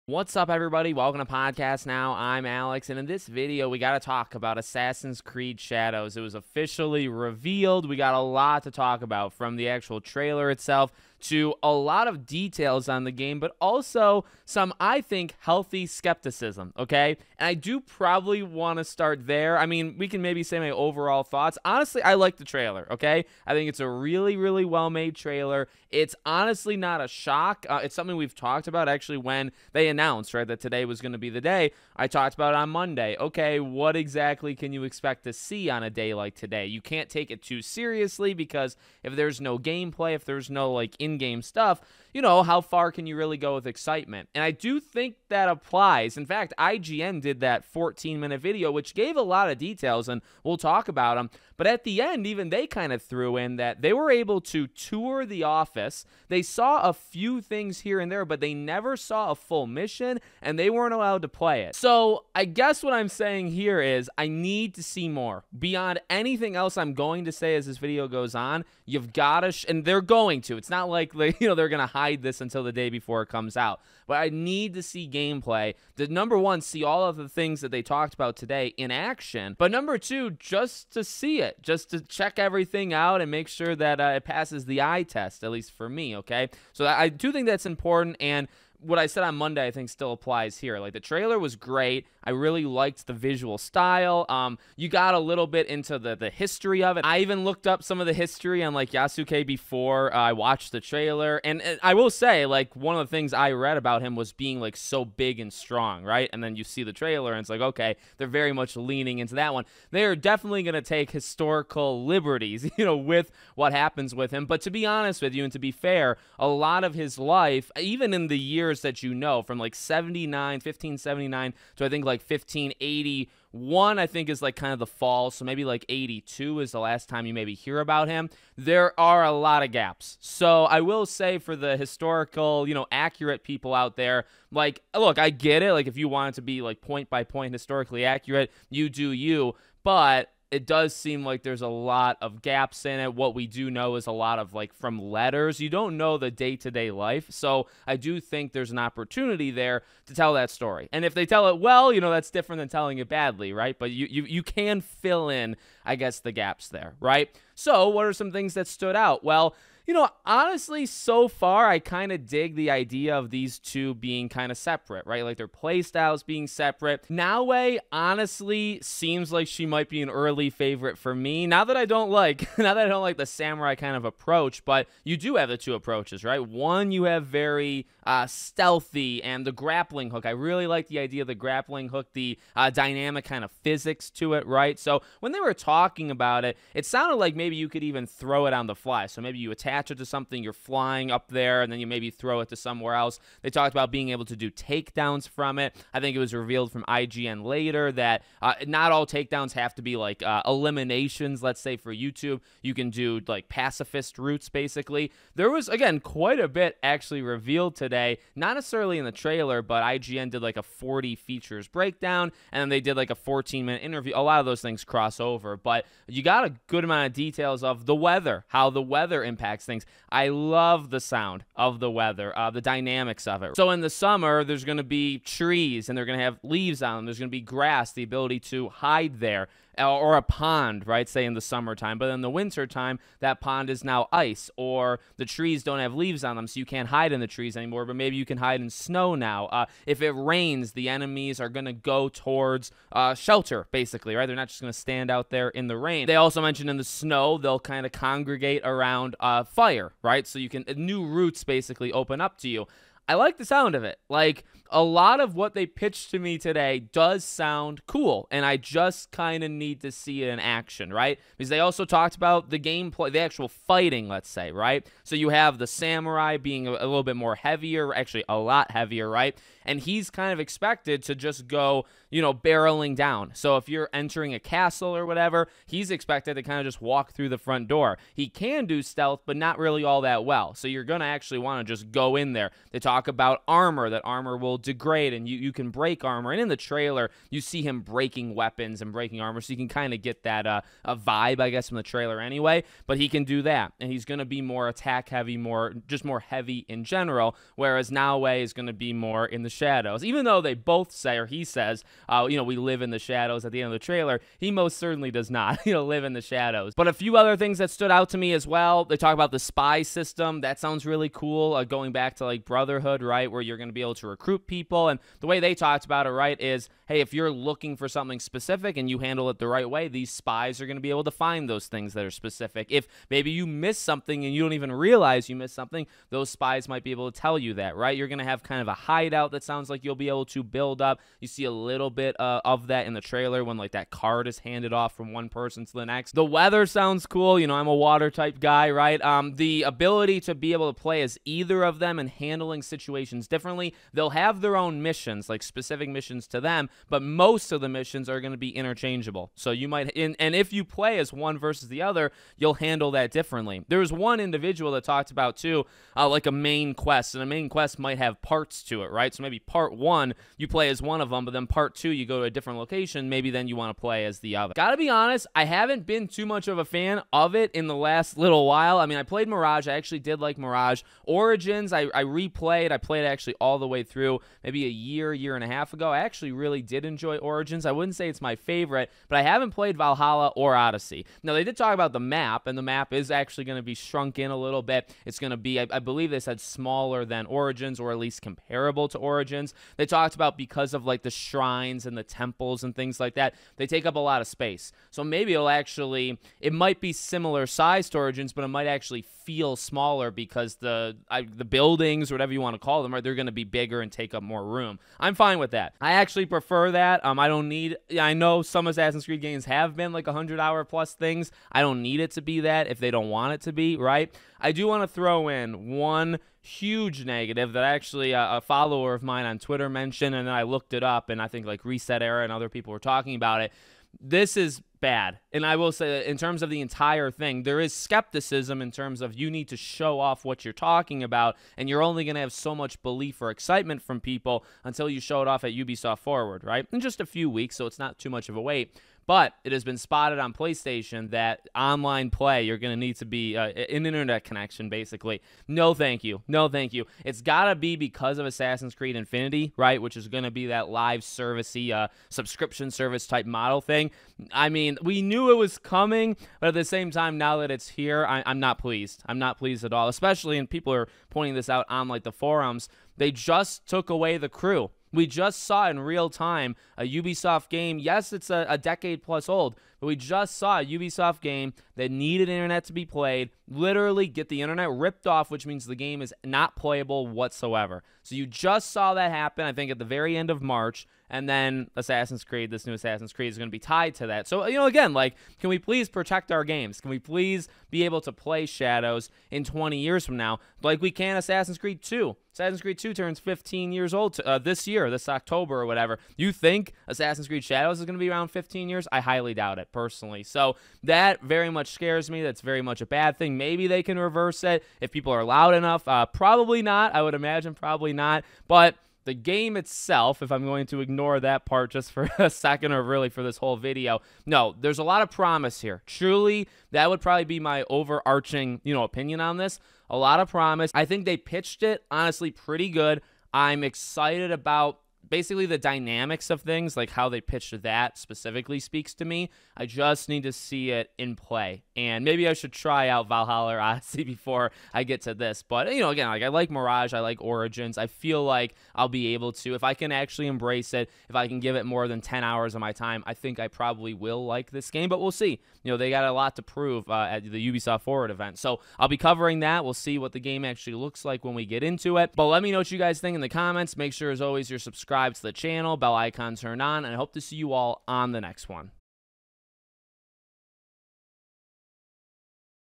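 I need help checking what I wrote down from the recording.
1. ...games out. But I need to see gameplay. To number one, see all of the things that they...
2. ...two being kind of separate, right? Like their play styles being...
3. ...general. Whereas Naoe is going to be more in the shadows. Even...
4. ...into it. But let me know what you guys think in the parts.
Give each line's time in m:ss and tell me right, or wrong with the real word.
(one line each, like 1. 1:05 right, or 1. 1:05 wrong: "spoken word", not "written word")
1. 1:13 wrong: "comes", not "games"
2. 2:43 right
3. 4:56 right
4. 9:11 wrong: "comments", not "parts".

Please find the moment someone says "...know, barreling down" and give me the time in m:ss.
4:32.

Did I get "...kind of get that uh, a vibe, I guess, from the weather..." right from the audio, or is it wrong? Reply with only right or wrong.
wrong.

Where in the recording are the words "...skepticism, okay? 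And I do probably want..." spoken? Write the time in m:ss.
0:15.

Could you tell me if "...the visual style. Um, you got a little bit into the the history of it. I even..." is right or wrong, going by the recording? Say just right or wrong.
right.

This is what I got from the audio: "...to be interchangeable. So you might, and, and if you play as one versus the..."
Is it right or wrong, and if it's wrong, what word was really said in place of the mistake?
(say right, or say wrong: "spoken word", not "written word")
right.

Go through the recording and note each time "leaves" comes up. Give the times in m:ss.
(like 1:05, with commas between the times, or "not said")
3:46, 3:55.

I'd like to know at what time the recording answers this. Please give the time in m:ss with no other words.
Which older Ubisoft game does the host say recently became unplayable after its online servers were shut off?
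7:44.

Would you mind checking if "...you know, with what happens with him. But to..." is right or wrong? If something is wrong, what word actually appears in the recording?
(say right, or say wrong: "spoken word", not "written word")
right.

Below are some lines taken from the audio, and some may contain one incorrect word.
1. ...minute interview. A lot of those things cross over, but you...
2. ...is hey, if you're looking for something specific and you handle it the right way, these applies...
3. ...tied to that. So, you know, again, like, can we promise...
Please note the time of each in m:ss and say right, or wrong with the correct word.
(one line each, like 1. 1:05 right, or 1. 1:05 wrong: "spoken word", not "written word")
1. 3:33 right
2. 5:16 wrong: "spies", not "applies"
3. 8:03 wrong: "please", not "promise".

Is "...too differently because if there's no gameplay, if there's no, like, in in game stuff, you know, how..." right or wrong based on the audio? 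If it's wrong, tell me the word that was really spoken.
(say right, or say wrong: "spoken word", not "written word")
wrong: "seriously", not "differently".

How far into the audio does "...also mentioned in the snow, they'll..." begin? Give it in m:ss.
4:06.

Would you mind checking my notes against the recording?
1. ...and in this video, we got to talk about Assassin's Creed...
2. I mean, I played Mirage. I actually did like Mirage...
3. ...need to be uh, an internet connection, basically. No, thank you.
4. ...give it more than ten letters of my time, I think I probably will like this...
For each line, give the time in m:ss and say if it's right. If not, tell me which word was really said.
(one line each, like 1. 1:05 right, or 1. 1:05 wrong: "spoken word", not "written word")
1. 0:02 right
2. 6:08 right
3. 7:22 right
4. 9:01 wrong: "hours", not "letters".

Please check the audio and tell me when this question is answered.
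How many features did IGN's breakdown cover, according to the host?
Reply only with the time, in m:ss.
3:30.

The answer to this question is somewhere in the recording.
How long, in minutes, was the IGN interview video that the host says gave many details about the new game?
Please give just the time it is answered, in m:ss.
0:47.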